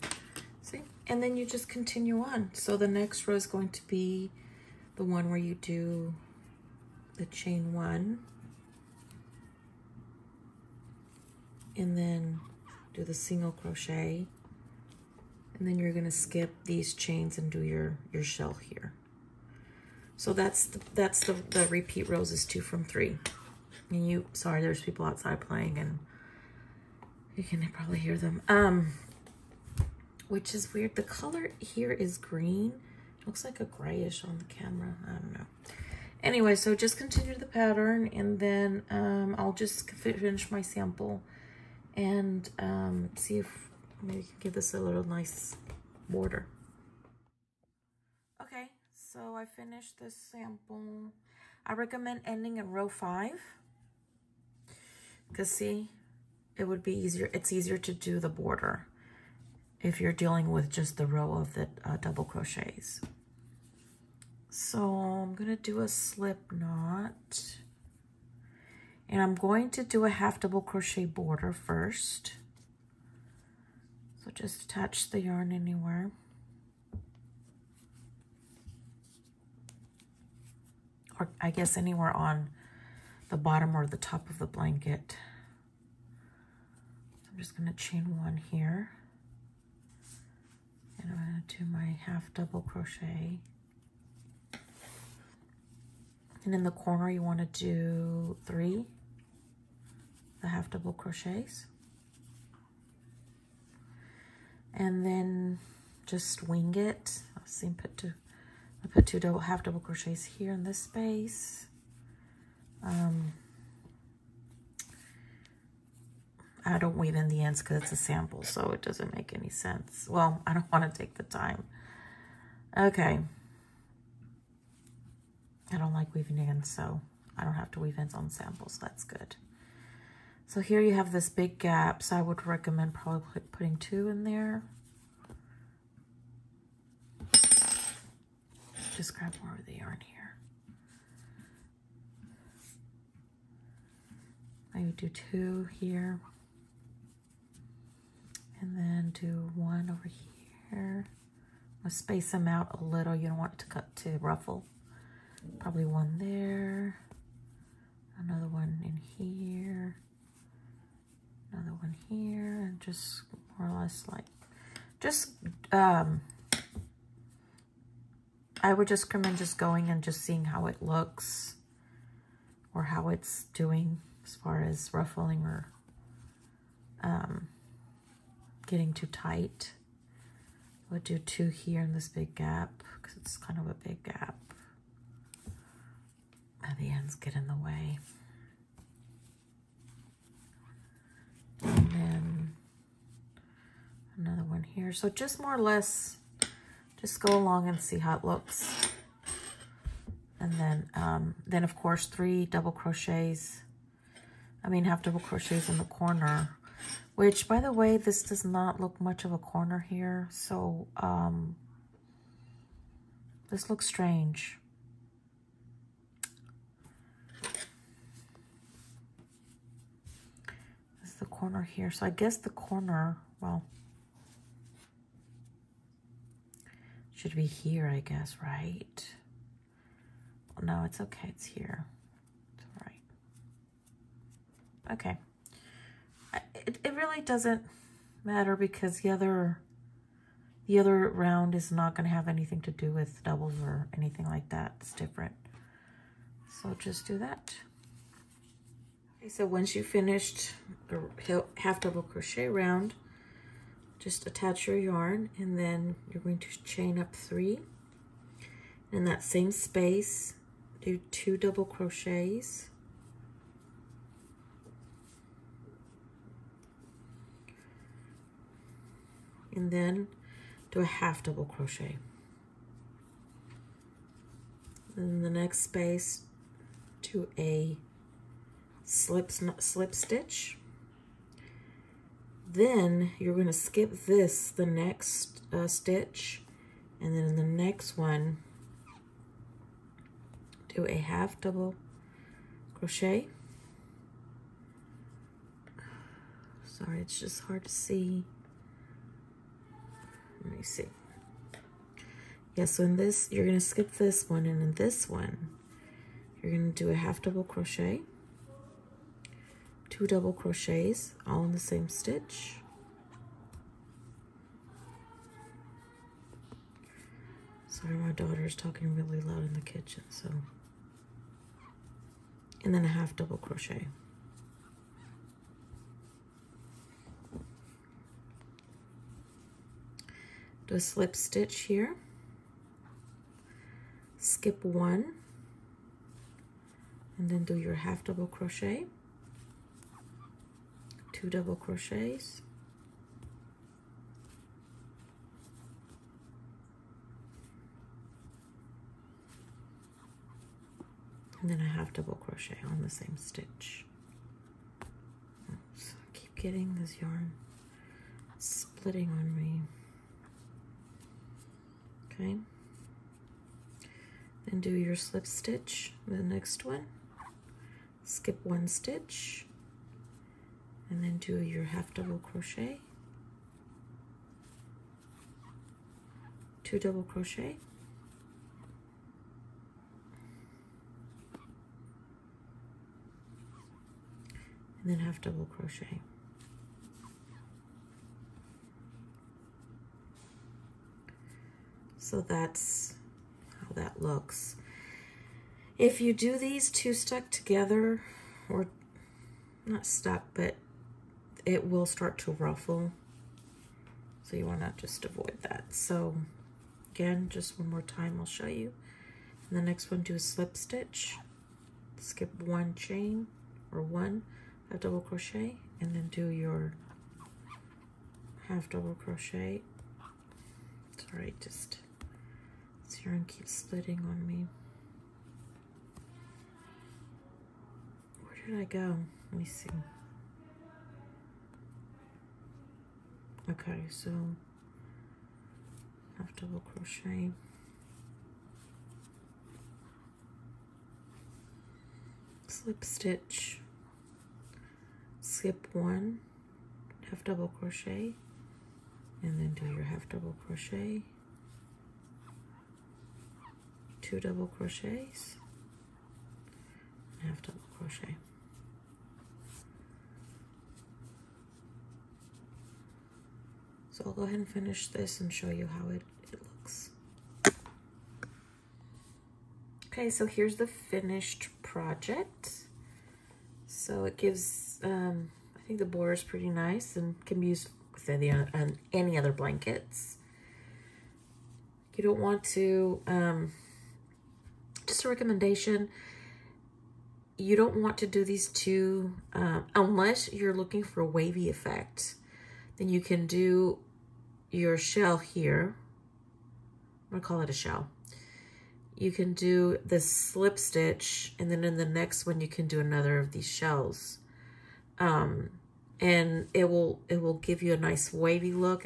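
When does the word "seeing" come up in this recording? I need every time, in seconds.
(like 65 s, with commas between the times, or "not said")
170 s.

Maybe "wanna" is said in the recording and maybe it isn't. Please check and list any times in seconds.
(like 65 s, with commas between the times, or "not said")
404 s.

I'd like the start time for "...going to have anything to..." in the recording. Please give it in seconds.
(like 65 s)
241 s.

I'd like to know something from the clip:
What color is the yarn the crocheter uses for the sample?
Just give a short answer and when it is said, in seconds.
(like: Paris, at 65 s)
Green, at 32 s.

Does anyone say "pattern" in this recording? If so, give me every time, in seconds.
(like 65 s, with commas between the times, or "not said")
37 s.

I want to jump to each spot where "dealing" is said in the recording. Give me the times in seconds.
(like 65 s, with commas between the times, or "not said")
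60 s.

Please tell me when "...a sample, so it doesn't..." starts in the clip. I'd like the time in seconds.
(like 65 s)
117 s.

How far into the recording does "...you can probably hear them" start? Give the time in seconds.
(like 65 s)
27 s.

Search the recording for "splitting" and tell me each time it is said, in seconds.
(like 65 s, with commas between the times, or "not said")
358 s, 423 s.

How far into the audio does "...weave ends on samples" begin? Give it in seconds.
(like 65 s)
127 s.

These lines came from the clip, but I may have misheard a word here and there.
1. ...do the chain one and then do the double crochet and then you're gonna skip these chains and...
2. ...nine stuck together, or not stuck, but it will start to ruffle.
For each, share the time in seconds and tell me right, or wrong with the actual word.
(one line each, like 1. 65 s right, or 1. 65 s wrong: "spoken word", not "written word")
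1. 5 s wrong: "single", not "double"
2. 396 s wrong: "two", not "nine".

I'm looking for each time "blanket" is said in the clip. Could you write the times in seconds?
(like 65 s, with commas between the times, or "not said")
84 s, 479 s.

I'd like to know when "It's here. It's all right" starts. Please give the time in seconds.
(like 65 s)
231 s.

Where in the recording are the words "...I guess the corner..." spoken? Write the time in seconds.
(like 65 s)
222 s.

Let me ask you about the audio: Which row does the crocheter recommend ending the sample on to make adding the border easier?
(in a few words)
Row 5.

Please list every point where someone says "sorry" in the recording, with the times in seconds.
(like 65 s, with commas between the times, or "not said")
24 s, 296 s, 317 s, 421 s.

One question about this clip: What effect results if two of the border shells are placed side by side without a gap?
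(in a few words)
Wavy effect.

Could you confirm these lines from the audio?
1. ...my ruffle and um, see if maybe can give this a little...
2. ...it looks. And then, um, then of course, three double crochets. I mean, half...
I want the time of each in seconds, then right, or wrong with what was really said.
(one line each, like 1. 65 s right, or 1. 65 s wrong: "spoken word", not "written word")
1. 40 s wrong: "sample", not "ruffle"
2. 198 s right.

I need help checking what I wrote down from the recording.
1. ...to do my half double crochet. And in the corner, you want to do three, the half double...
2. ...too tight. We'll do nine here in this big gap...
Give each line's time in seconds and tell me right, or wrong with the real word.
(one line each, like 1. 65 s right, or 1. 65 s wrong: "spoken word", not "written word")
1. 91 s right
2. 178 s wrong: "two", not "nine".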